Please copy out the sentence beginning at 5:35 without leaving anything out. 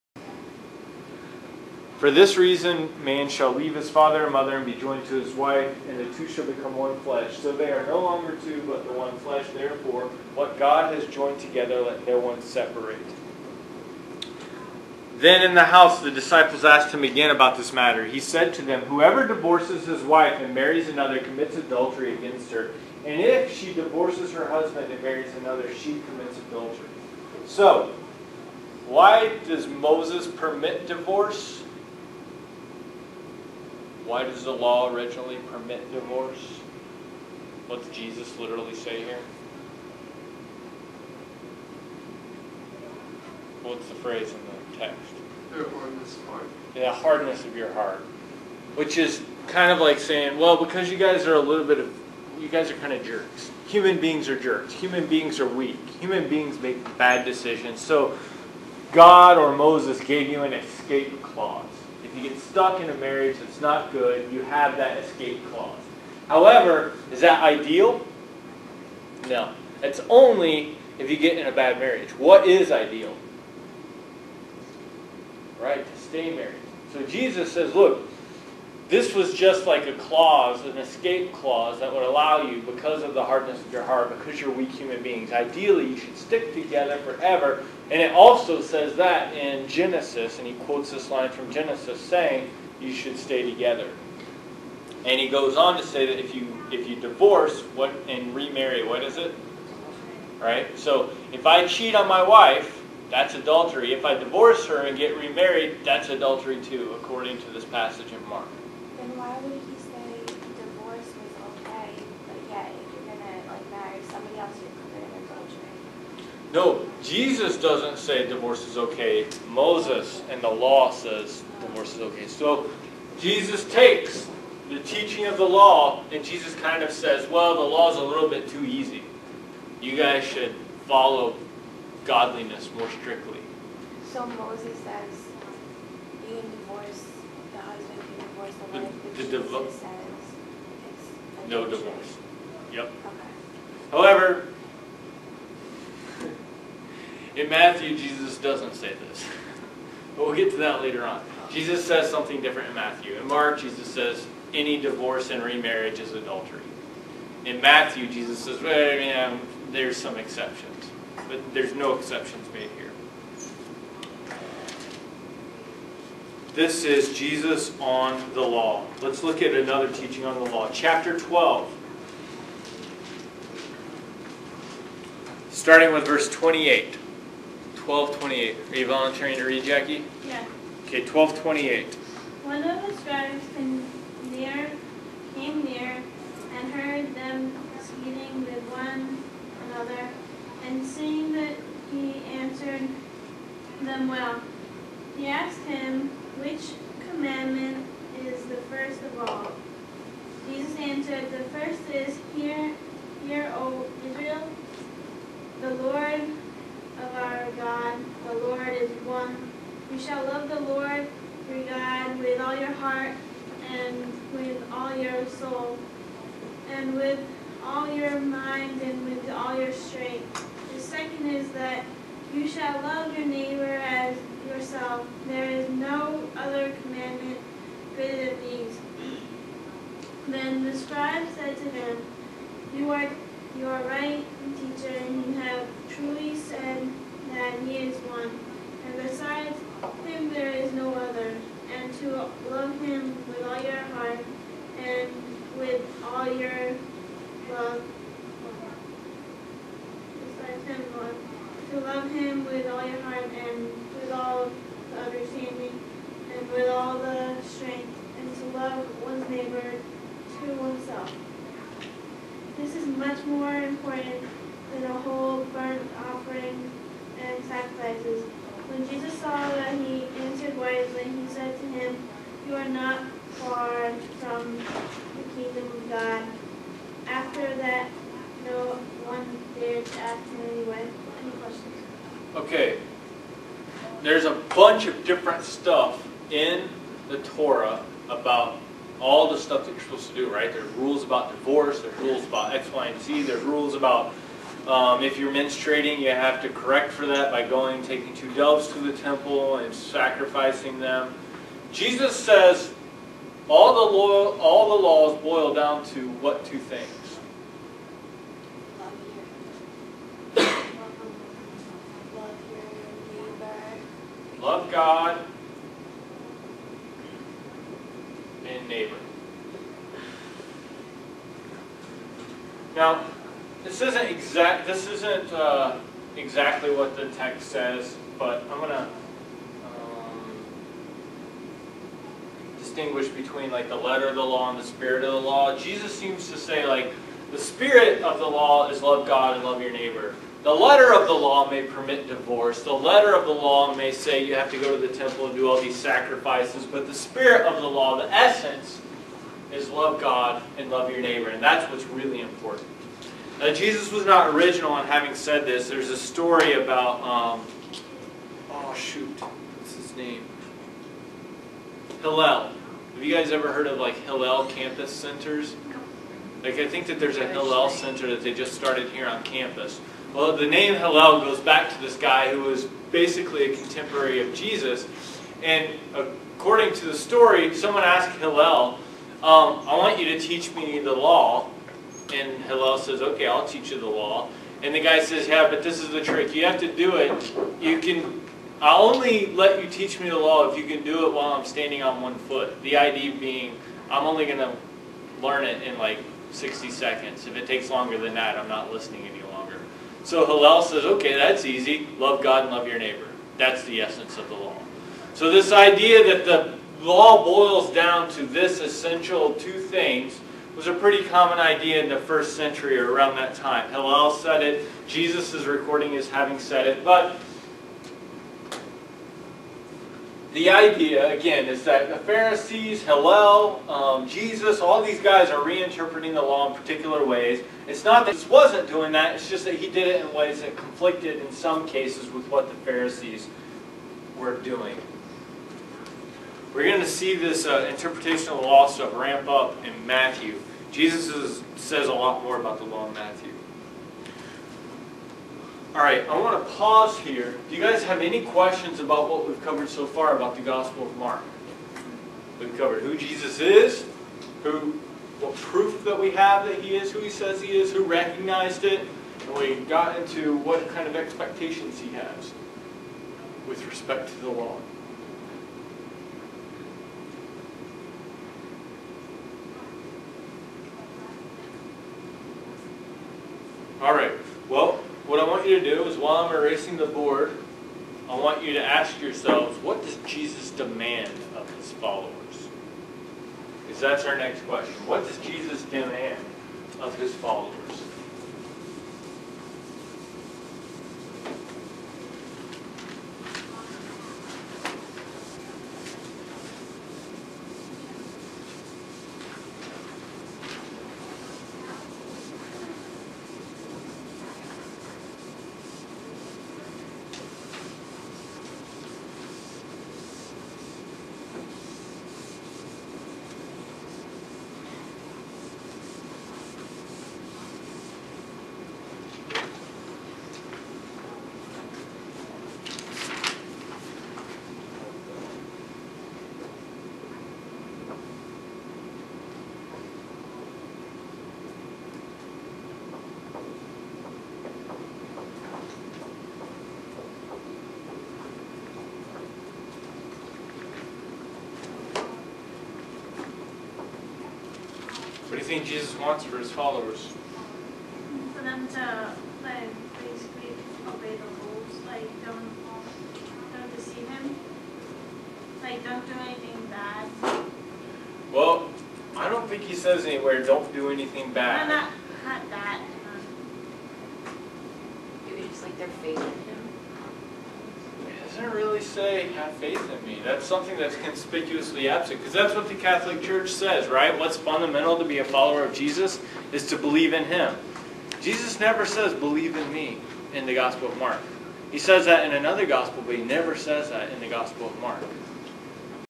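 Jesus seems to say like the spirit of the law is love God and love your neighbor.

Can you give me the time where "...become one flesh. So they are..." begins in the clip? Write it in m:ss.
0:06.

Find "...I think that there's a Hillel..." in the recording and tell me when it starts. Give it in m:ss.
6:06.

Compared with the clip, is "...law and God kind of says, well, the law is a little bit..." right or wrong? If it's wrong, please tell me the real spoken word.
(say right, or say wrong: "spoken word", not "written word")
wrong: "Jesus", not "God".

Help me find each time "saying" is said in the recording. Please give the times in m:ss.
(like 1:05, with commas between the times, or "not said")
0:49, 1:31.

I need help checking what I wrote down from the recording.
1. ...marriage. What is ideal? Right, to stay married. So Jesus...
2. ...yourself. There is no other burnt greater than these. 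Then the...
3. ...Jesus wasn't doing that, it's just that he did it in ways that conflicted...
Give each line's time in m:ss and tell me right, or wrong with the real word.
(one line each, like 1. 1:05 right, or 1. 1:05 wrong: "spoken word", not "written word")
1. 1:11 right
2. 3:44 wrong: "commandment", not "burnt"
3. 7:08 right.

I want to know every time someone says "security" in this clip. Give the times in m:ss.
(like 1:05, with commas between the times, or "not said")
not said.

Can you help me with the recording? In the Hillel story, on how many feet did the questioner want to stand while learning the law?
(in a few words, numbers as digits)
1.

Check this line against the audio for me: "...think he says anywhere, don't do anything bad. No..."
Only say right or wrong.
right.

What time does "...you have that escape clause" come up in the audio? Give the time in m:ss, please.
1:04.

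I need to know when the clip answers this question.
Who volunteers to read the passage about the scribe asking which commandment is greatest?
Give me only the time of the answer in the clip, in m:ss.
2:59.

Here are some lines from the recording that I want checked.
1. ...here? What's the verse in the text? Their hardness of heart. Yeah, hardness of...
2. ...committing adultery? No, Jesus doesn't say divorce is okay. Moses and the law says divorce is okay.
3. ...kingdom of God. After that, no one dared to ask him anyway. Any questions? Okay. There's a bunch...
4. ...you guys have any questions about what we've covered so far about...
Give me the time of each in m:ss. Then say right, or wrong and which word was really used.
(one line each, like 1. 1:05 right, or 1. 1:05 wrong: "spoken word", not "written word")
1. 0:39 wrong: "phrase", not "verse"
2. 1:54 right
3. 4:35 right
4. 7:27 right.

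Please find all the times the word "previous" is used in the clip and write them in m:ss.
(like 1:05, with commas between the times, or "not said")
not said.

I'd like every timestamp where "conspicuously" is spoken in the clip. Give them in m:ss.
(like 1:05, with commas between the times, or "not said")
9:30.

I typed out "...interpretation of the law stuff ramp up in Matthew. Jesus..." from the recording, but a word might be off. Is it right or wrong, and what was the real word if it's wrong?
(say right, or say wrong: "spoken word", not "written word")
right.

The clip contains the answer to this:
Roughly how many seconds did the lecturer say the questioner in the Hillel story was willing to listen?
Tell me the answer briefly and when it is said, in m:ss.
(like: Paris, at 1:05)
60, at 6:36.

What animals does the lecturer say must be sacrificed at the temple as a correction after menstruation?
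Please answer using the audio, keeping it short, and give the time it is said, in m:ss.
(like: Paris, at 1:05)
two doves, at 4:58.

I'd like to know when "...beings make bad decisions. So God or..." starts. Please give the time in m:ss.
0:56.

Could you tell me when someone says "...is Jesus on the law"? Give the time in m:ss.
2:46.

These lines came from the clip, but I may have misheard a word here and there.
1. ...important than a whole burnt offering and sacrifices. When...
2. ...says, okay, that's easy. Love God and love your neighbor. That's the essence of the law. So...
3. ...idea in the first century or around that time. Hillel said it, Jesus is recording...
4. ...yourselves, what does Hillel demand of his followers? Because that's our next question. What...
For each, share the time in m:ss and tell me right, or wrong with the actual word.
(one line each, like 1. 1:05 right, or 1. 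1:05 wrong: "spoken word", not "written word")
1. 4:23 right
2. 6:40 right
3. 6:51 right
4. 7:58 wrong: "Jesus", not "Hillel".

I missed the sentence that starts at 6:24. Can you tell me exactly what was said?
And the guy says, yeah, but this is the trick.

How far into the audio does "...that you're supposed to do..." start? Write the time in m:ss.
4:49.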